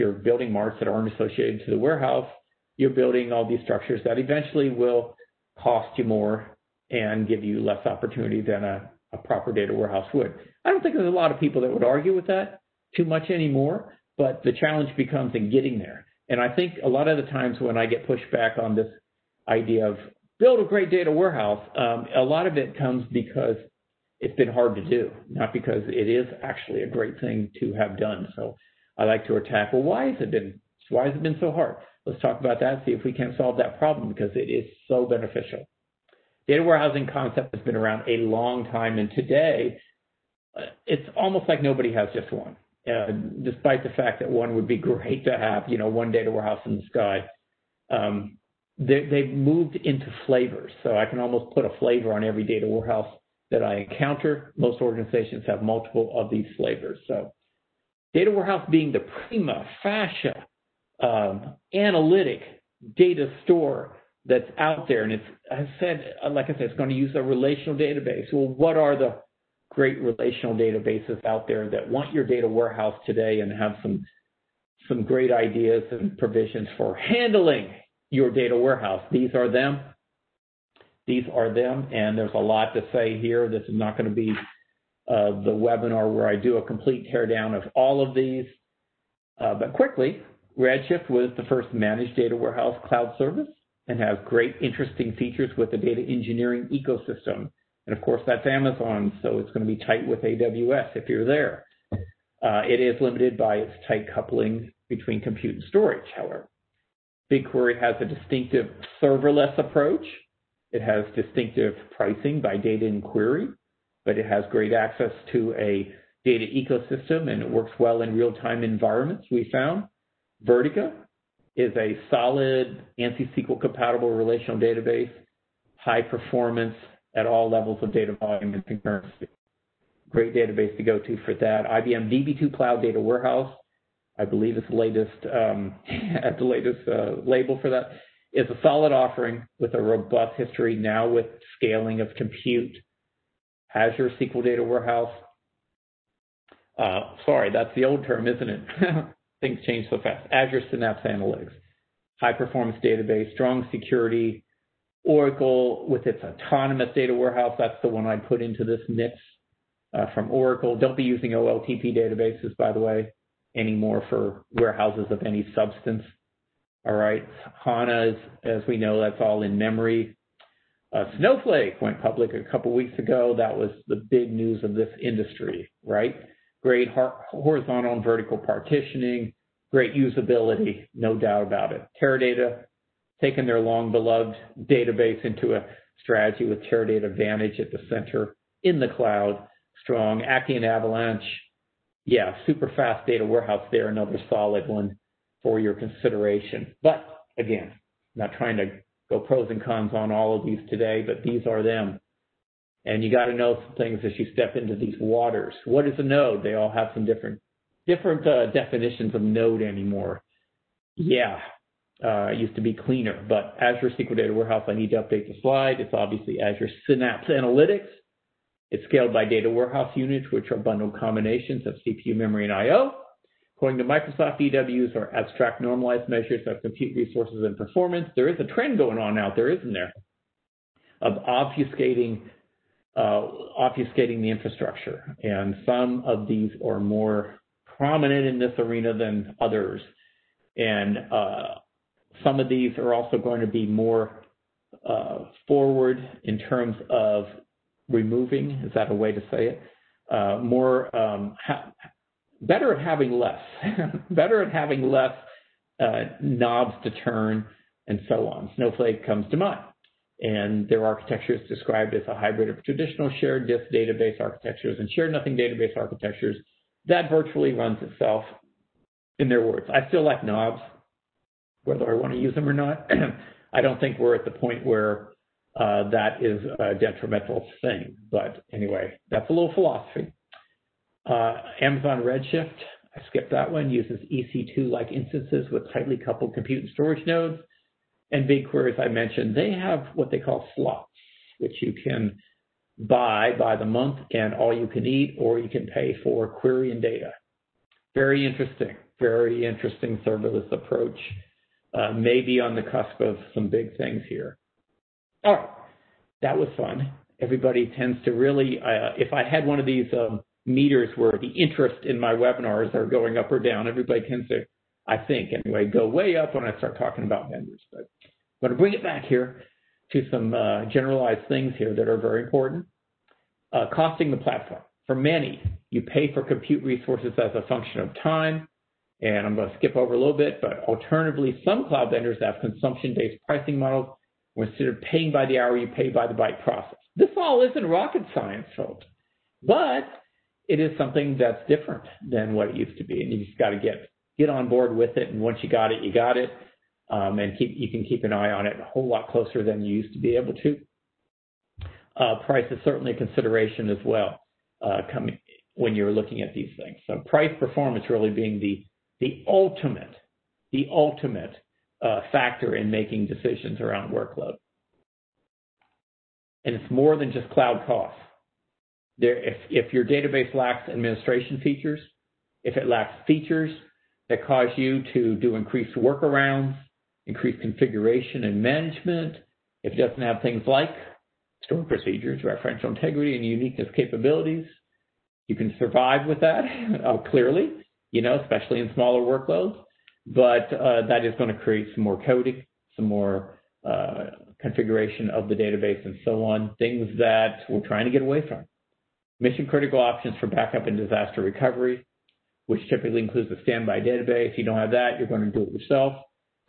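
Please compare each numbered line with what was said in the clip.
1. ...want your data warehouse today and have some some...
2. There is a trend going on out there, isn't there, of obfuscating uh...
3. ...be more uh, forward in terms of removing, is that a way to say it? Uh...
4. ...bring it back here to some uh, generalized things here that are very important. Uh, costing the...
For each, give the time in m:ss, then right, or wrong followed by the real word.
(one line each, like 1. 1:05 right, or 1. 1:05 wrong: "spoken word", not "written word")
1. 1:11 right
2. 3:48 right
3. 4:03 right
4. 5:18 right.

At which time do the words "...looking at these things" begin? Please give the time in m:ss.
5:55.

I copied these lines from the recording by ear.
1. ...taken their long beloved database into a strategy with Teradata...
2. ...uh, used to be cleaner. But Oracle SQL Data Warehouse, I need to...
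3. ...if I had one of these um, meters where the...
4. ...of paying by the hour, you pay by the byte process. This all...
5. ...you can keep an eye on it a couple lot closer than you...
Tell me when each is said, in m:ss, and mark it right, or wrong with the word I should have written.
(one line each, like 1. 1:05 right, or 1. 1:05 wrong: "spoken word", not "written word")
1. 3:03 right
2. 3:32 wrong: "Azure", not "Oracle"
3. 5:08 right
4. 5:34 right
5. 5:47 wrong: "whole", not "couple".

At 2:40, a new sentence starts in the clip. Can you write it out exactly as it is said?
Don't be using OLTP databases, by the way, anymore for warehouses of any substance.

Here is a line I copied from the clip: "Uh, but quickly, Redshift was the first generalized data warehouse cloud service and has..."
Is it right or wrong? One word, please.
wrong.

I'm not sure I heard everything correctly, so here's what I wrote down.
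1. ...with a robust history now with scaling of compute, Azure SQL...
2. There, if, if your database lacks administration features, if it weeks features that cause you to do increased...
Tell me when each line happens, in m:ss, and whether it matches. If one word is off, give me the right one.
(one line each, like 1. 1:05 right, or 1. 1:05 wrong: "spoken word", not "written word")
1. 2:19 right
2. 6:08 wrong: "lacks", not "weeks".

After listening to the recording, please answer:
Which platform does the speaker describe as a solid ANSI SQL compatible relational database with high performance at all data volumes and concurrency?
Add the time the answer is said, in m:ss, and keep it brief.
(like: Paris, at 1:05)
Vertica, at 2:00.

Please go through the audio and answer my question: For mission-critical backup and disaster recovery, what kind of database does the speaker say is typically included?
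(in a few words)
standby database.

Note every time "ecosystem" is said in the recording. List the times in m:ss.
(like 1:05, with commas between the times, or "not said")
1:36, 1:56.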